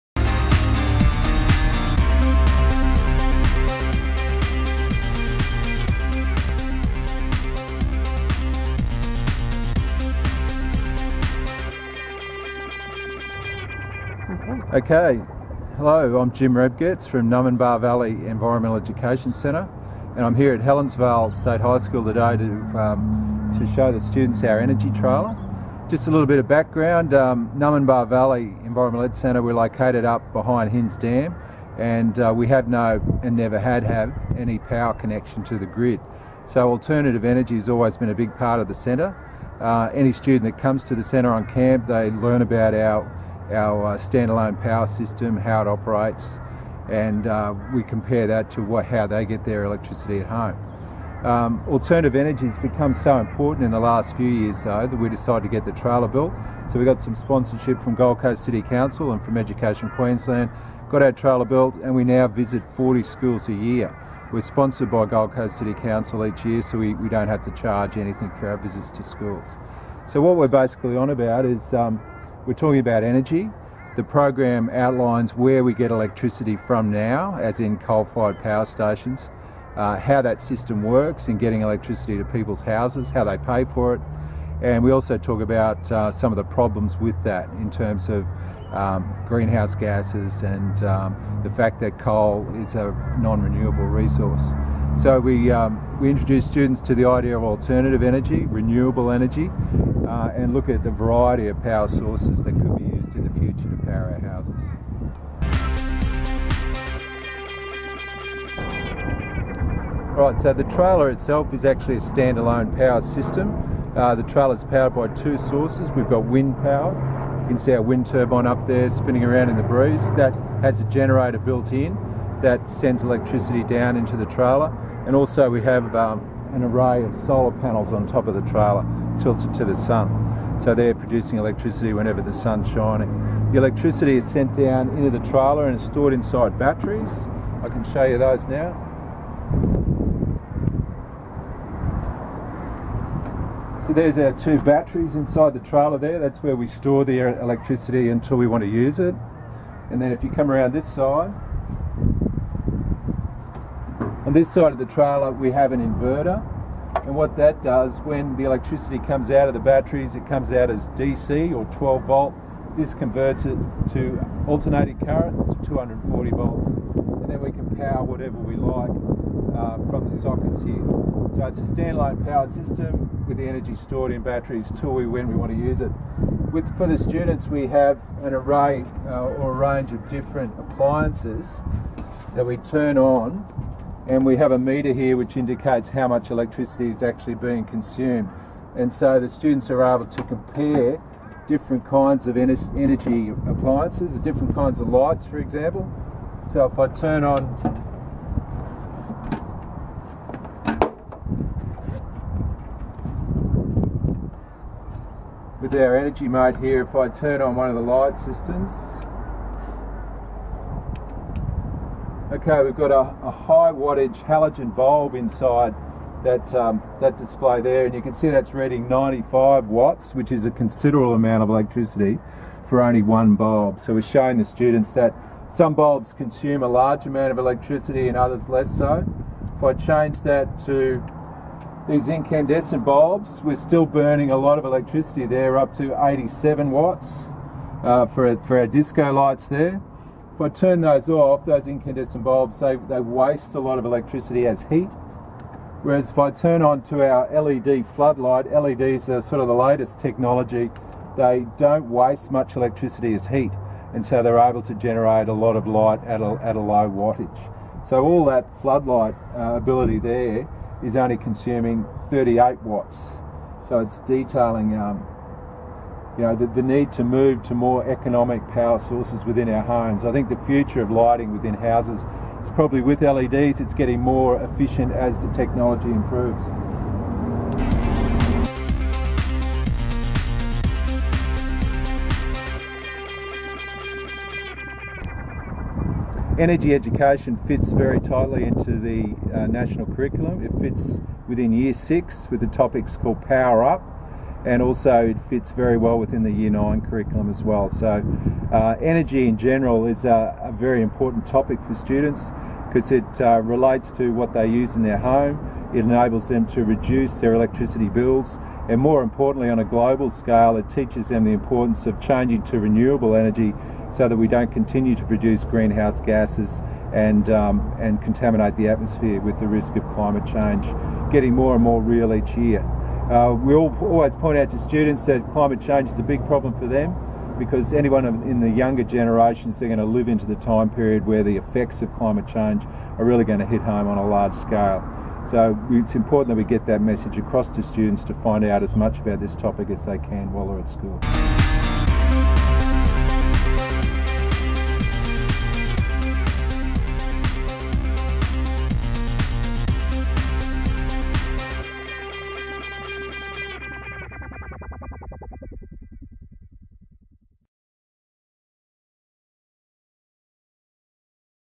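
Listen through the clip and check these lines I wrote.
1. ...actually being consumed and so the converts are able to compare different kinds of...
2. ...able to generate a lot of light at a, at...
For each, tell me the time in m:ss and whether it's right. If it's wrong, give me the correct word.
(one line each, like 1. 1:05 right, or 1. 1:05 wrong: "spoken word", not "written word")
1. 3:07 wrong: "students", not "converts"
2. 4:14 right.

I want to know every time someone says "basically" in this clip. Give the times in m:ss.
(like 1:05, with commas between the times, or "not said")
1:10.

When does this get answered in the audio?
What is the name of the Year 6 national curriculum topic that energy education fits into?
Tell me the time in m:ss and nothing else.
4:53.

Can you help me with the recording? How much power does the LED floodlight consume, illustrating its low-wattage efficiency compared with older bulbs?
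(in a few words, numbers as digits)
38 watts.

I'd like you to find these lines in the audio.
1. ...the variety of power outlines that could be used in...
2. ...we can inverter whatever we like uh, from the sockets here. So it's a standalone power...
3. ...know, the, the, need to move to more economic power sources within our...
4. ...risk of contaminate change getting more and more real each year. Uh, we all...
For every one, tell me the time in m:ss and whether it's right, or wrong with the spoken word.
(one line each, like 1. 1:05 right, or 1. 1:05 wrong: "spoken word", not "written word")
1. 1:40 wrong: "sources", not "outlines"
2. 2:47 wrong: "power", not "inverter"
3. 4:26 right
4. 5:19 wrong: "climate", not "contaminate".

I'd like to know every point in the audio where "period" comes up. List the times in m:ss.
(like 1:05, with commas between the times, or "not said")
5:30.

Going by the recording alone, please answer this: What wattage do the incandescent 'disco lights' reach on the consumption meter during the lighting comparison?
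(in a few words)
87 watts.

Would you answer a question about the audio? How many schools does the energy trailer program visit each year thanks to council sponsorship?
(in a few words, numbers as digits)
40.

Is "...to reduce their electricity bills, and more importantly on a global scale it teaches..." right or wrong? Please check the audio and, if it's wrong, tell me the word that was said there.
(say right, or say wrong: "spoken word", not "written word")
right.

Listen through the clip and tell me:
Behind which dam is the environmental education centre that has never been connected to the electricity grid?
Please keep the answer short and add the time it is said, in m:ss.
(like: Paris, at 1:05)
Hinze Dam, at 0:30.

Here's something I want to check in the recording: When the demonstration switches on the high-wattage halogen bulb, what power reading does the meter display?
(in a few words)
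95 watts.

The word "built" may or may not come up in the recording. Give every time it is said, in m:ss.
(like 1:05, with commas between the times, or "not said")
0:56, 1:01, 2:01.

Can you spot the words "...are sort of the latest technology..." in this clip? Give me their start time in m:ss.
4:09.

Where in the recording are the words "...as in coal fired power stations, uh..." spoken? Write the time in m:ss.
1:17.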